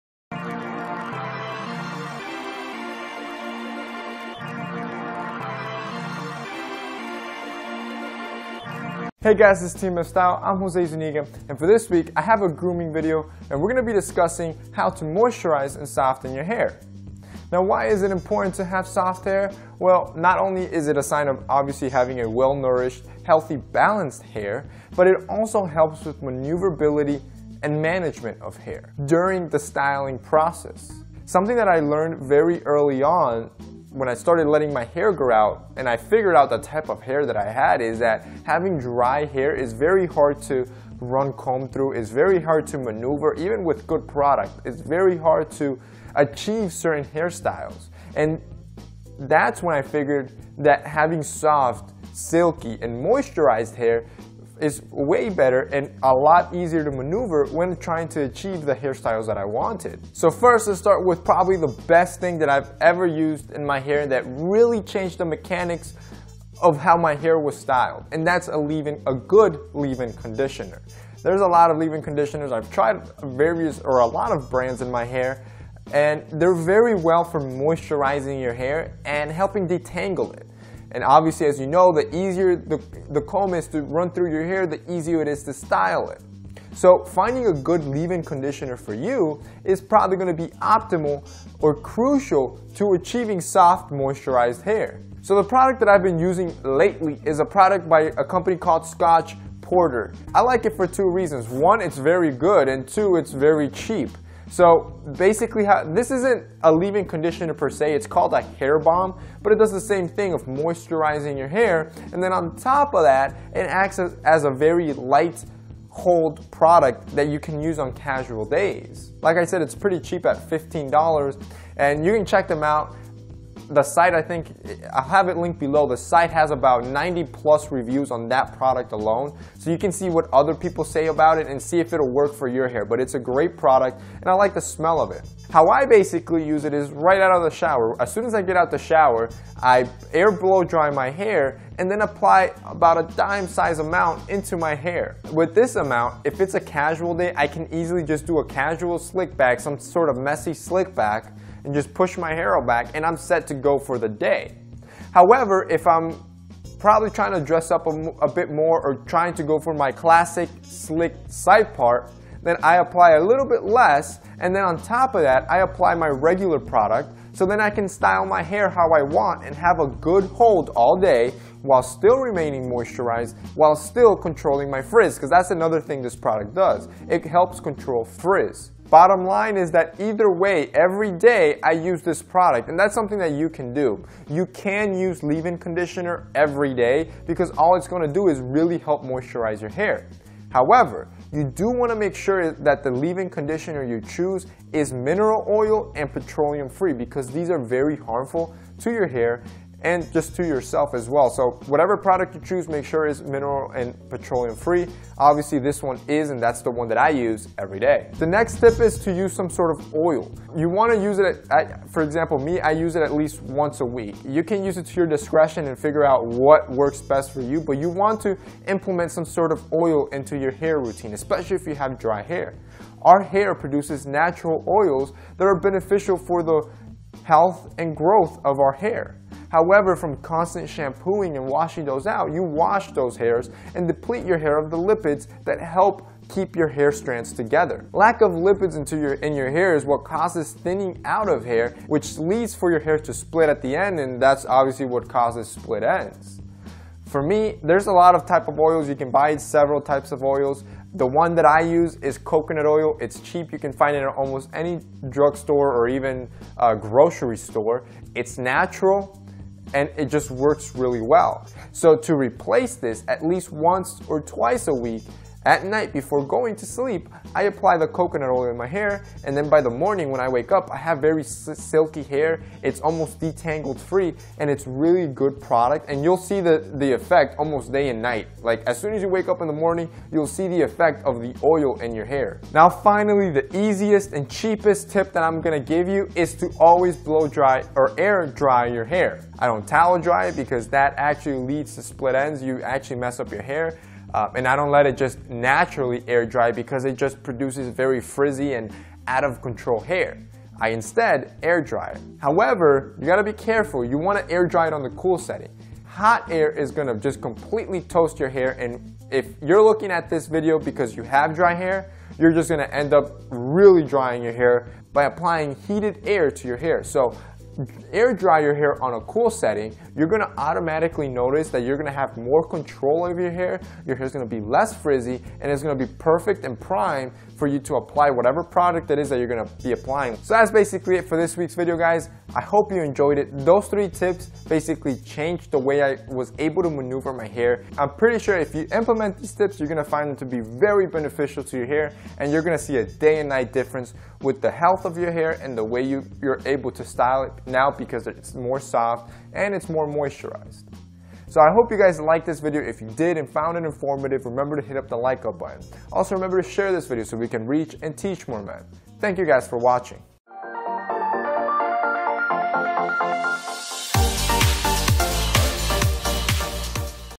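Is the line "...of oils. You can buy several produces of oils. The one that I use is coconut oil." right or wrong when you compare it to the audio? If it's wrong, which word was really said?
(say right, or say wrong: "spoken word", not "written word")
wrong: "types", not "produces".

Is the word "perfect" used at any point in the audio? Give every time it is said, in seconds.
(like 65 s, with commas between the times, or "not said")
325 s.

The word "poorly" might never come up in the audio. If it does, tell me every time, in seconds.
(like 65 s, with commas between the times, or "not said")
not said.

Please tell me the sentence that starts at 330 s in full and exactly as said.
So that's basically it for this week's video, guys.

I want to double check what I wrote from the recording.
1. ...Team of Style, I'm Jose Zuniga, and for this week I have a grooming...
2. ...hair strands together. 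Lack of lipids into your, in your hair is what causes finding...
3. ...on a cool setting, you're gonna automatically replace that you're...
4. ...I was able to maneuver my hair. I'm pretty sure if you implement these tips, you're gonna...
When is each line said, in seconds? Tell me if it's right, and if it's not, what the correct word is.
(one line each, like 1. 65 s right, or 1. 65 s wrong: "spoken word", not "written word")
1. 9 s right
2. 236 s wrong: "thinning", not "finding"
3. 318 s wrong: "notice", not "replace"
4. 335 s right.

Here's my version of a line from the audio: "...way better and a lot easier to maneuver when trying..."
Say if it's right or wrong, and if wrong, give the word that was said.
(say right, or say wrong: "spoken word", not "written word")
right.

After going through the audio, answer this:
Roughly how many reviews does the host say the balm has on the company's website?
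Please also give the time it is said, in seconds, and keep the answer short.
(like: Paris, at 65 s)
90 plus, at 126 s.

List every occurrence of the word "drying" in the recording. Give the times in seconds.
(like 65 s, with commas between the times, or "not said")
313 s.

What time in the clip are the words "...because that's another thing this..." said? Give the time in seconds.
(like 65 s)
175 s.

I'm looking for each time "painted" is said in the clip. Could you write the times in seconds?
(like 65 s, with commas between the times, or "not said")
not said.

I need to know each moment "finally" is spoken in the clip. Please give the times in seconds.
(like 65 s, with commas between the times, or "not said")
282 s.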